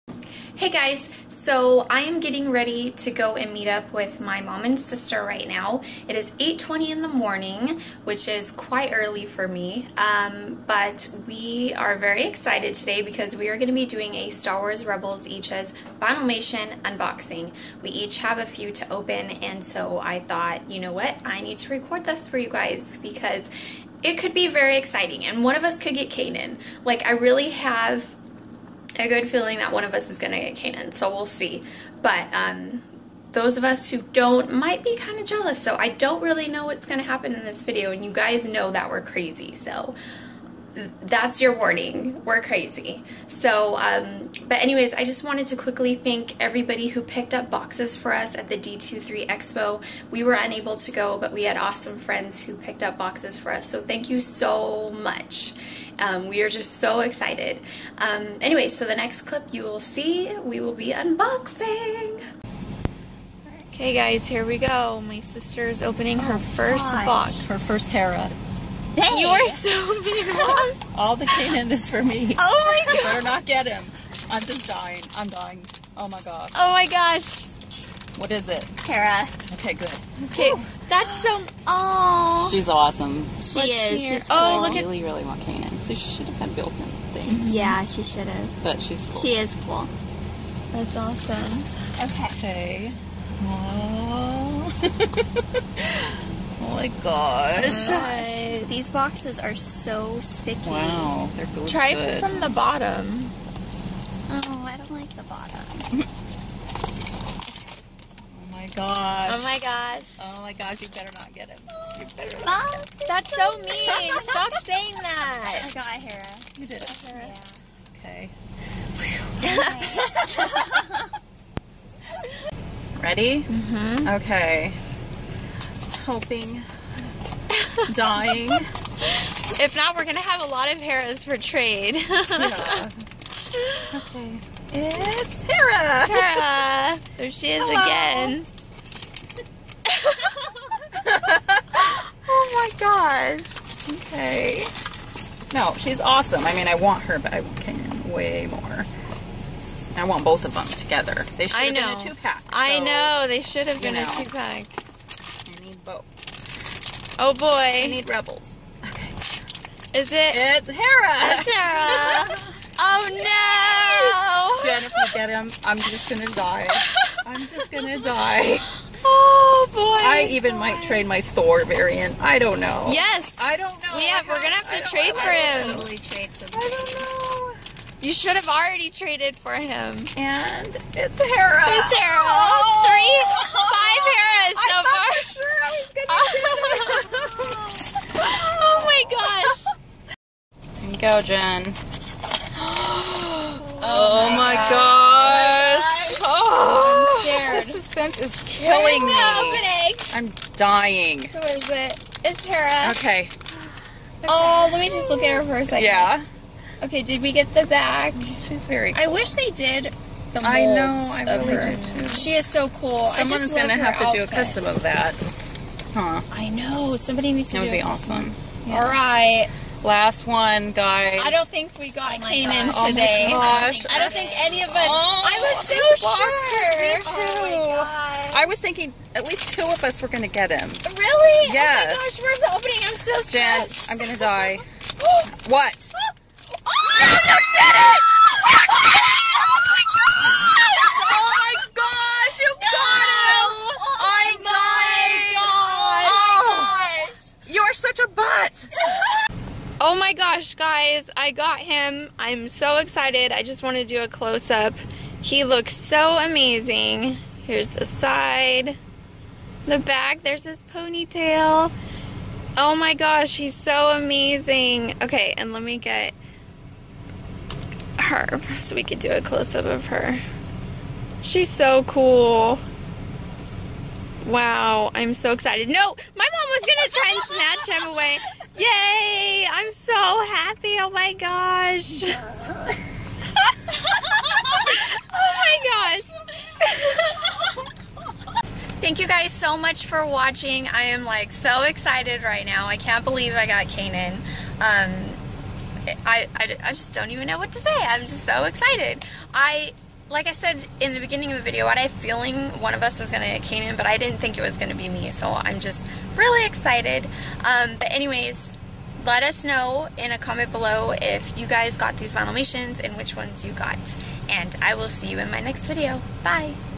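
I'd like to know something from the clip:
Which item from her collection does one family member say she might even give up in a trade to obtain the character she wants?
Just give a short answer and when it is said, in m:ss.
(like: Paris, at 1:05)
Thor variant, at 2:51.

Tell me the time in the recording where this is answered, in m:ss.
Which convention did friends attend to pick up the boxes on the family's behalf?
0:48.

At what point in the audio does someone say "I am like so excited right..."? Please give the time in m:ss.
4:50.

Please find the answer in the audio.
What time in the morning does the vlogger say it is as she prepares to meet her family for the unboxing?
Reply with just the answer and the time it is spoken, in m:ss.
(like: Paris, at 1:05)
8:20, at 0:06.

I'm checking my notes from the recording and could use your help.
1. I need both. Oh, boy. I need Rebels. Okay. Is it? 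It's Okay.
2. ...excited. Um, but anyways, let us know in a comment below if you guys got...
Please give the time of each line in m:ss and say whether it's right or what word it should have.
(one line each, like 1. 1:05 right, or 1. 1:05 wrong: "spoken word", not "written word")
1. 2:34 wrong: "Hera", not "Okay"
2. 5:06 right.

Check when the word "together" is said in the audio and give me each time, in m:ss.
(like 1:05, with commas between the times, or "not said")
2:30.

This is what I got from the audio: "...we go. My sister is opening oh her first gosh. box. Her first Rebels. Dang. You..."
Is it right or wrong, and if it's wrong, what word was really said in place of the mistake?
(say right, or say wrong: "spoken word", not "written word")
wrong: "Hera", not "Rebels".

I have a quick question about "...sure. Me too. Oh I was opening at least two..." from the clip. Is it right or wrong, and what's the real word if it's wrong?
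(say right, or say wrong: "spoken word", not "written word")
wrong: "thinking", not "opening".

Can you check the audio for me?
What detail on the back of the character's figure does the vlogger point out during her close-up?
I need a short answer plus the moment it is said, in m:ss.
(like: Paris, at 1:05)
ponytail, at 4:20.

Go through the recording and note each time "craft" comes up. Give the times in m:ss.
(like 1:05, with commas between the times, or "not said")
not said.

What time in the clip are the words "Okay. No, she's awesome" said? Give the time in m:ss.
2:24.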